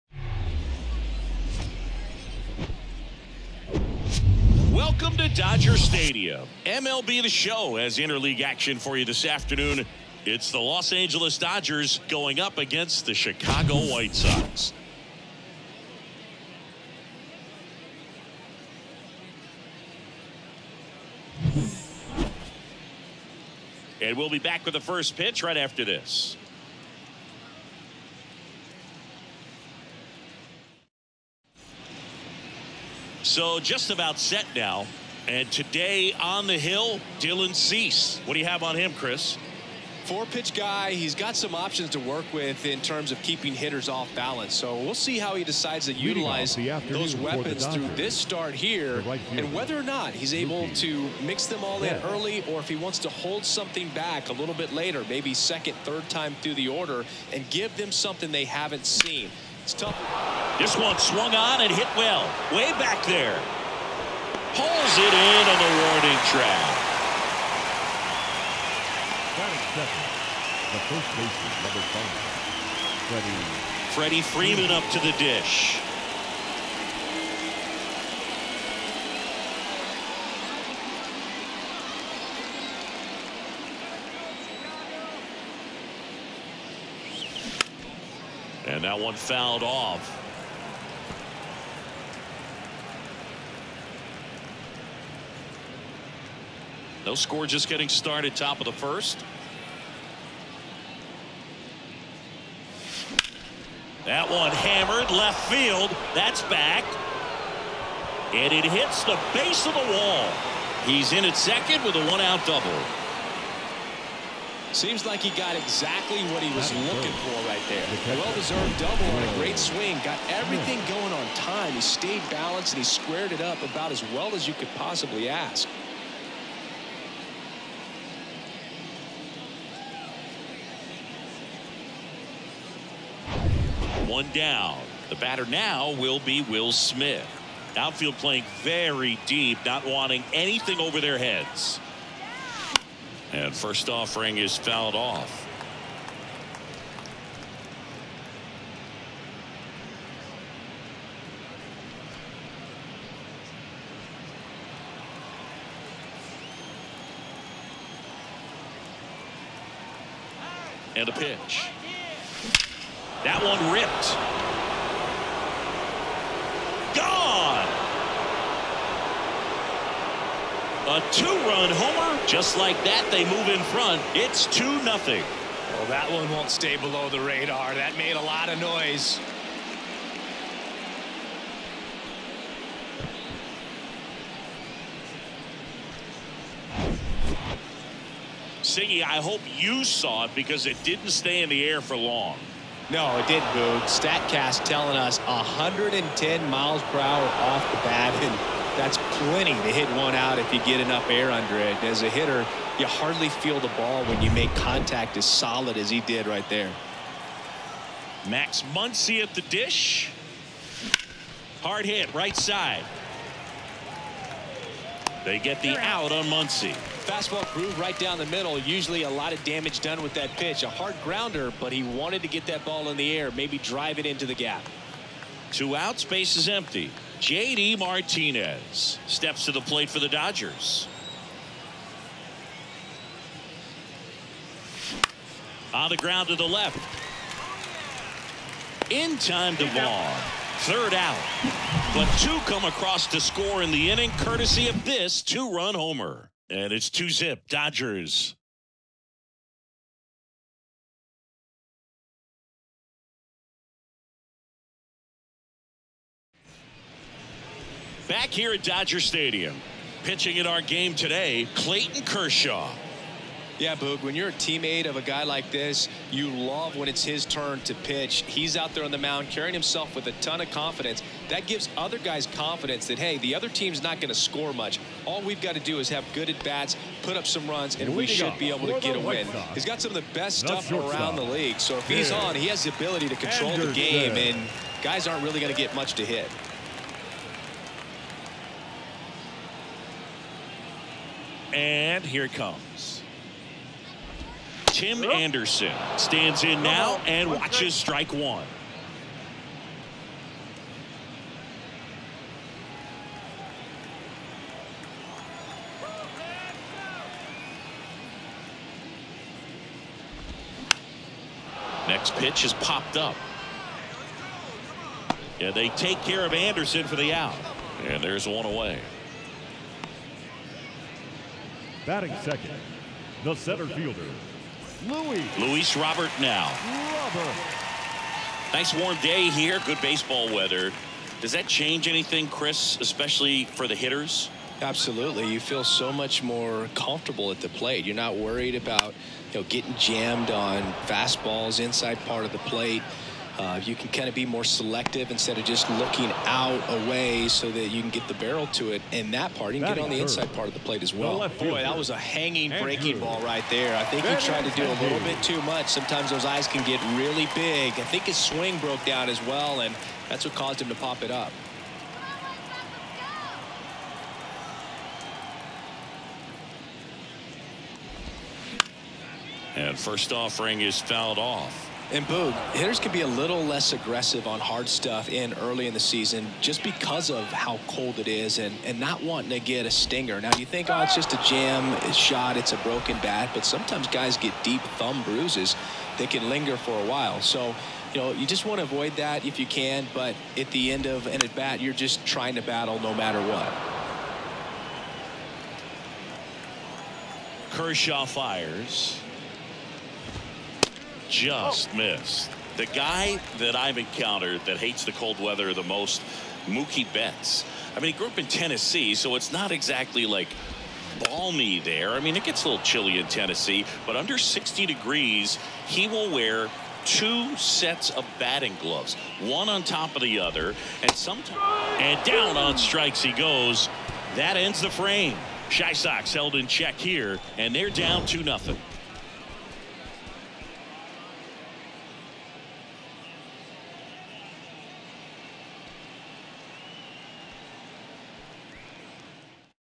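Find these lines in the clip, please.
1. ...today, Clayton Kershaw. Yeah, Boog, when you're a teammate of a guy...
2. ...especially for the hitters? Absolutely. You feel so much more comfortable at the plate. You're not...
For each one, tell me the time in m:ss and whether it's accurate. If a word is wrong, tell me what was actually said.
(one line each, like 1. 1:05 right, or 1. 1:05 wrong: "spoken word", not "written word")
1. 4:20 right
2. 5:32 right.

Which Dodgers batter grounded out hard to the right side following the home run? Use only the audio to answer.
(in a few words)
Max Muncy.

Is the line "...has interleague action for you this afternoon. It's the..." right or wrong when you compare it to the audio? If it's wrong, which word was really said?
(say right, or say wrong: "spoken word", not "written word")
right.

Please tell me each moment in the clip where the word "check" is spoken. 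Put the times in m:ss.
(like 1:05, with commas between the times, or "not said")
7:06.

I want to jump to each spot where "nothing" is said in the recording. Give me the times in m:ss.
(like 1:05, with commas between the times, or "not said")
2:54, 7:08.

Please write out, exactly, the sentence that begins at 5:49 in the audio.
You can that get on the inside part of the plate as well.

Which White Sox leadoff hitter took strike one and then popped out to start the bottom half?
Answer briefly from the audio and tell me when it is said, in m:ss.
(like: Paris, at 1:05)
Tim Anderson, at 4:54.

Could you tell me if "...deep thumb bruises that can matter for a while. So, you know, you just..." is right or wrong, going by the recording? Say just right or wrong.
wrong.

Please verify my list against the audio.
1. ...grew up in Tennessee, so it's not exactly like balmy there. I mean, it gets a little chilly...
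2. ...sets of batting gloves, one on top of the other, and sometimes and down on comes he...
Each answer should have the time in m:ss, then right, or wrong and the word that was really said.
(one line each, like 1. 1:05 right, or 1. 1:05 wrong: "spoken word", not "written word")
1. 6:47 right
2. 6:57 wrong: "strikes", not "comes".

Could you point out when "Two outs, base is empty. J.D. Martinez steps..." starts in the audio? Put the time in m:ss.
3:45.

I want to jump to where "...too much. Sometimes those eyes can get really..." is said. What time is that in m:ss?
5:55.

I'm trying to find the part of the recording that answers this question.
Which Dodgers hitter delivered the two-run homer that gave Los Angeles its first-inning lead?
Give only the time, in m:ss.
2:16.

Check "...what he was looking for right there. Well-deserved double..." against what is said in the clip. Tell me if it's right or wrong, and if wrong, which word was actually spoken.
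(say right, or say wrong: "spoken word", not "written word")
right.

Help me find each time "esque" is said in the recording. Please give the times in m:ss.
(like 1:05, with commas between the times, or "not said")
not said.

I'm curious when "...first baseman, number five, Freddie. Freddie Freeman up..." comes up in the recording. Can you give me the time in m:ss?
1:10.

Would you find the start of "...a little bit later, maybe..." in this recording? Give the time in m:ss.
0:54.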